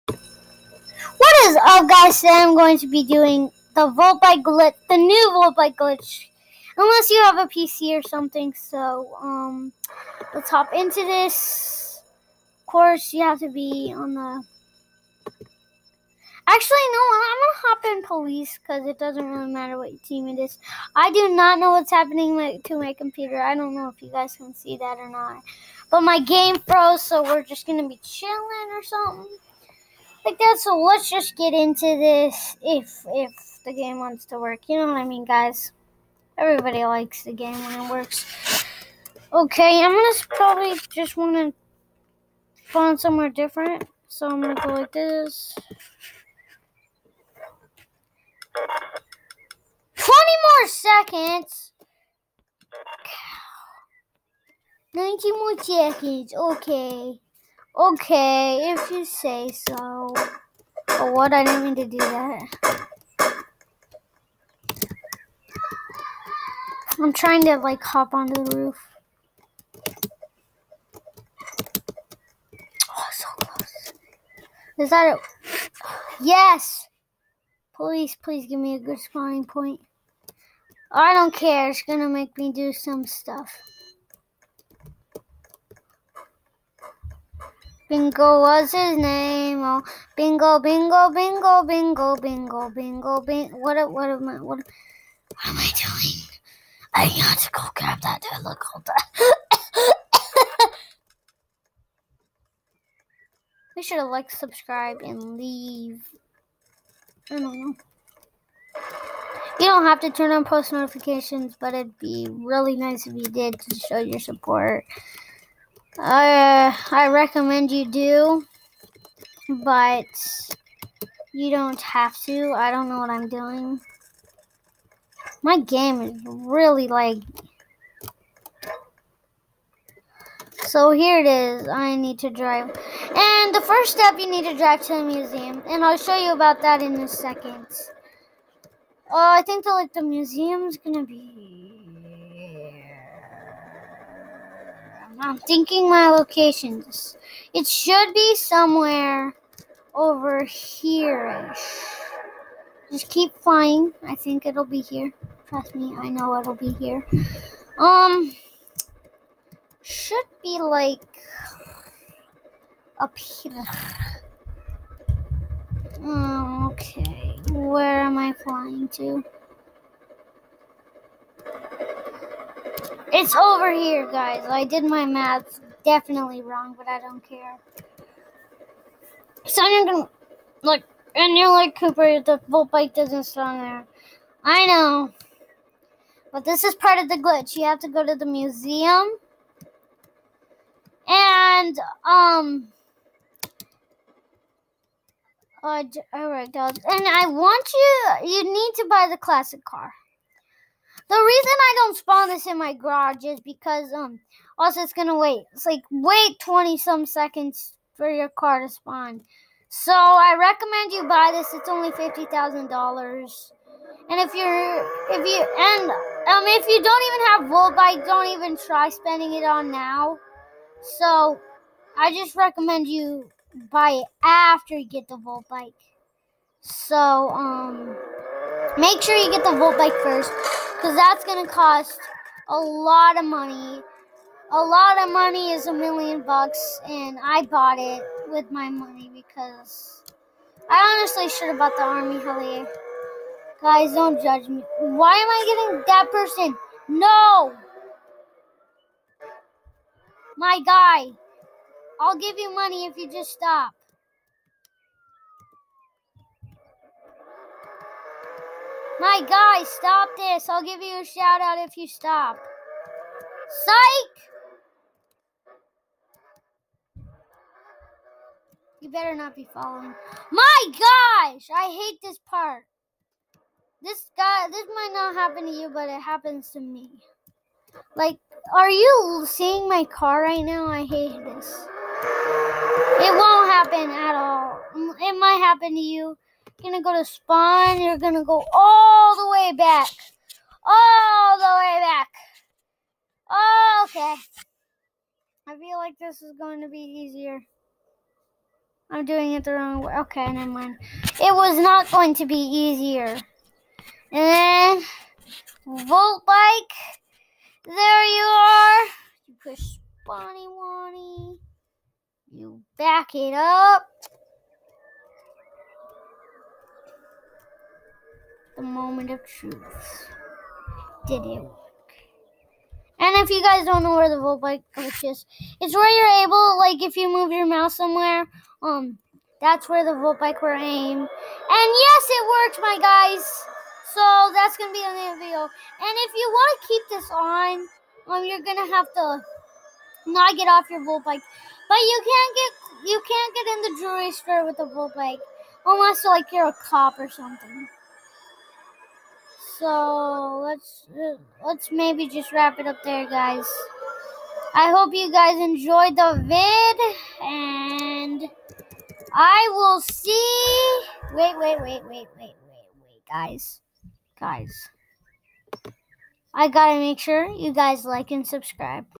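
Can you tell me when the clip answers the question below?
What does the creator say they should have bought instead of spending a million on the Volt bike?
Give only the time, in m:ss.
4:01.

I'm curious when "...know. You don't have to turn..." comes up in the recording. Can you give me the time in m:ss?
1:47.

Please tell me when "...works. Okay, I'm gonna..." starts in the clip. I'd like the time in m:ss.
0:37.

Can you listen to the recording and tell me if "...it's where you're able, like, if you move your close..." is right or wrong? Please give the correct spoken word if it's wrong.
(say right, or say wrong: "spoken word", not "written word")
wrong: "mouse", not "close".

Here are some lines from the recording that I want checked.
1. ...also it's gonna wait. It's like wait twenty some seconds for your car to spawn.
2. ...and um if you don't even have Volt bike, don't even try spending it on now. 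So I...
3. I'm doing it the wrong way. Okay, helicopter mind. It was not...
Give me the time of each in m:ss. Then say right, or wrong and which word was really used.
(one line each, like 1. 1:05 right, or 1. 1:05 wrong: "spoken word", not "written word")
1. 3:24 right
2. 3:35 right
3. 4:58 wrong: "never", not "helicopter".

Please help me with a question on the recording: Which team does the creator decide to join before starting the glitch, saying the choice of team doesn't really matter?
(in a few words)
police.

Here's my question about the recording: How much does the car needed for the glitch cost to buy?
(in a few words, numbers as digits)
$50,000.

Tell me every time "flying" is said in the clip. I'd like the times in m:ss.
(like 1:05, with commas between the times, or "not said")
2:33, 2:48.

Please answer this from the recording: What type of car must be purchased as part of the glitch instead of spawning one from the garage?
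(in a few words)
classic car.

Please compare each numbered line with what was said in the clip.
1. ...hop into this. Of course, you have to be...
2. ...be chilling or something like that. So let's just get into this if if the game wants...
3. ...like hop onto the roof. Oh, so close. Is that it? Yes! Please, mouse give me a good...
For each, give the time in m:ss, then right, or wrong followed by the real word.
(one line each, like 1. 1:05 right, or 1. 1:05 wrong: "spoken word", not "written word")
1. 0:10 right
2. 0:27 right
3. 1:07 wrong: "please", not "mouse".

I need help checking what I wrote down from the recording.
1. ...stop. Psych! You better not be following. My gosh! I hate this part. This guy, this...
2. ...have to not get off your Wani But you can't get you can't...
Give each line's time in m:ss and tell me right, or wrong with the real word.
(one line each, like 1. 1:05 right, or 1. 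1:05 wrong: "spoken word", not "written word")
1. 4:21 right
2. 5:38 wrong: "Volt", not "Wani".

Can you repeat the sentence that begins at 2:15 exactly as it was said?
And I'll show you about that in a second.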